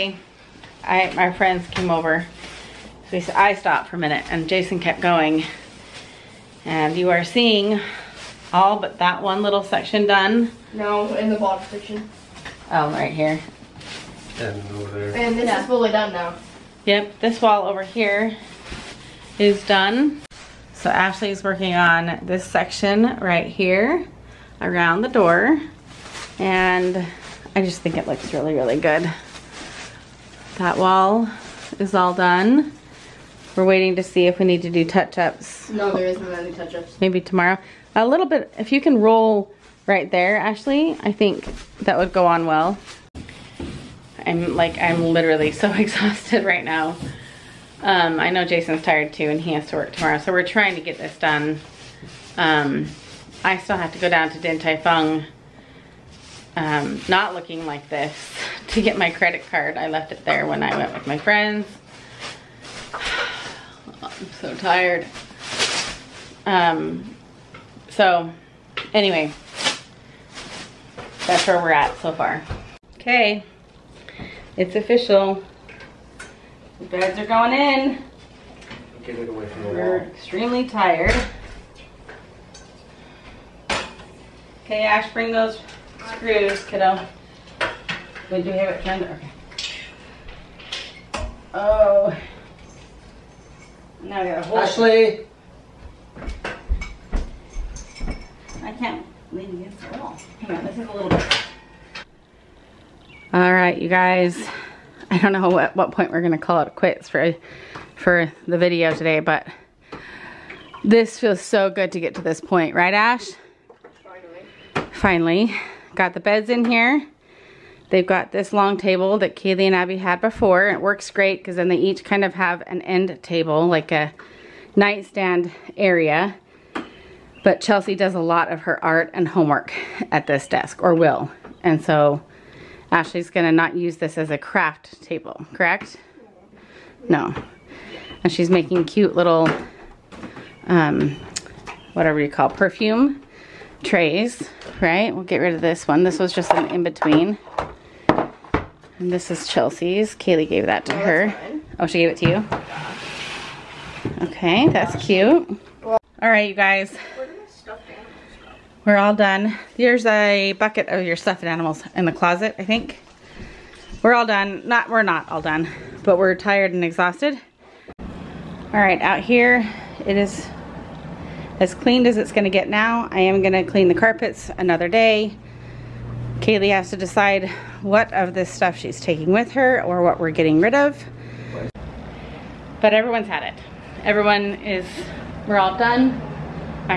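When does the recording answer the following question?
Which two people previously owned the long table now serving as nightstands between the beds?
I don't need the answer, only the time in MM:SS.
01:59.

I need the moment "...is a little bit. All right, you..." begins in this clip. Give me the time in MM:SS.
01:40.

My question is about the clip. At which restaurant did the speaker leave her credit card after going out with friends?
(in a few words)
Din Tai Fung.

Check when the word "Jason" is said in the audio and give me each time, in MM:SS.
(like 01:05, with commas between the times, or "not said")
00:04, 00:48.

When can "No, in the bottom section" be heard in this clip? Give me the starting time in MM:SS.
00:10.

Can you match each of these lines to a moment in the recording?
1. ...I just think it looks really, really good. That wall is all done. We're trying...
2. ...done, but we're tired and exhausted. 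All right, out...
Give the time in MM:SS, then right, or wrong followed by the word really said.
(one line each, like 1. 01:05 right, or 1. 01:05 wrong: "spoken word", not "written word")
1. 00:27 wrong: "waiting", not "trying"
2. 02:45 right.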